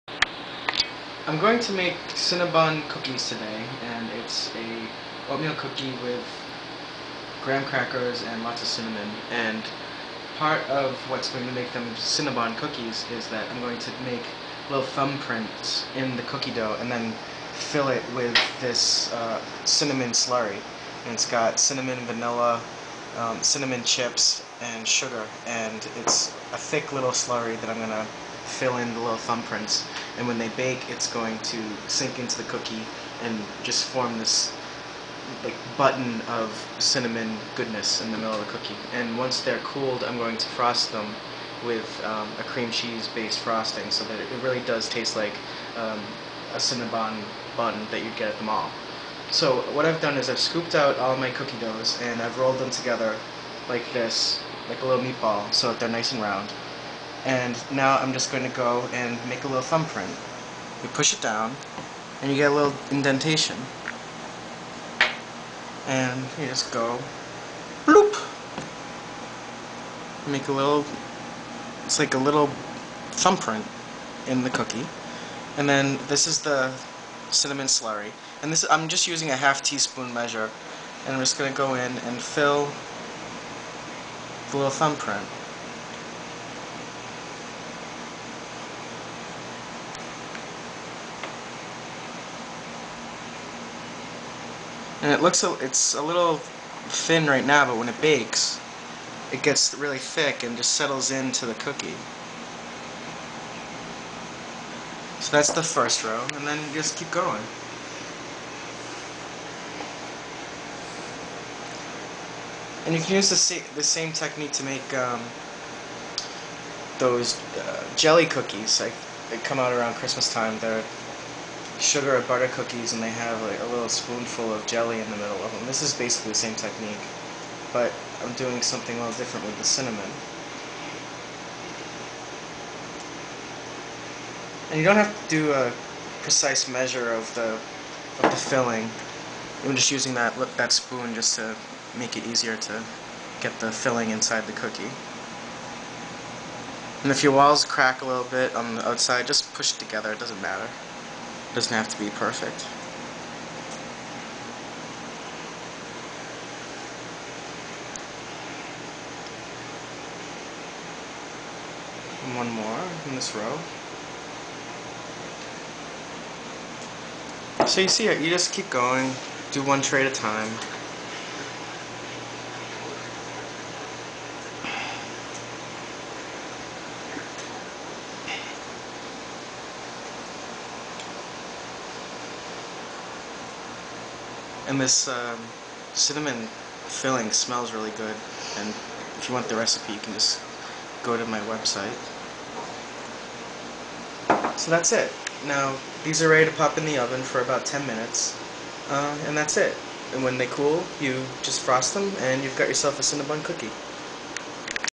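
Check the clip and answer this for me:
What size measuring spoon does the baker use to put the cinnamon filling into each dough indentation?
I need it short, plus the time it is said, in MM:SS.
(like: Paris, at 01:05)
half teaspoon, at 01:19.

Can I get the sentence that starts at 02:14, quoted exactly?
And you don't have to do a precise measure of the of the filling.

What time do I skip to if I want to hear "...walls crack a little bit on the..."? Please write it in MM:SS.
02:27.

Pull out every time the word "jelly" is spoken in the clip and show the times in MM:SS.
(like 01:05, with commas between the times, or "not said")
01:57, 02:04.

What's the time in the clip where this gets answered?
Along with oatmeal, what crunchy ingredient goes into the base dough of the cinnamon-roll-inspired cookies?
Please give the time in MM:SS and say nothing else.
00:07.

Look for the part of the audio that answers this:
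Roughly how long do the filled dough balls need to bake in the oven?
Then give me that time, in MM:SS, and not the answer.
03:17.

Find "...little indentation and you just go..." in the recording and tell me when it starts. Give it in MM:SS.
01:02.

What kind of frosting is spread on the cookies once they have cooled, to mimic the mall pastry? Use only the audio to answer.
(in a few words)
cream cheese-based frosting.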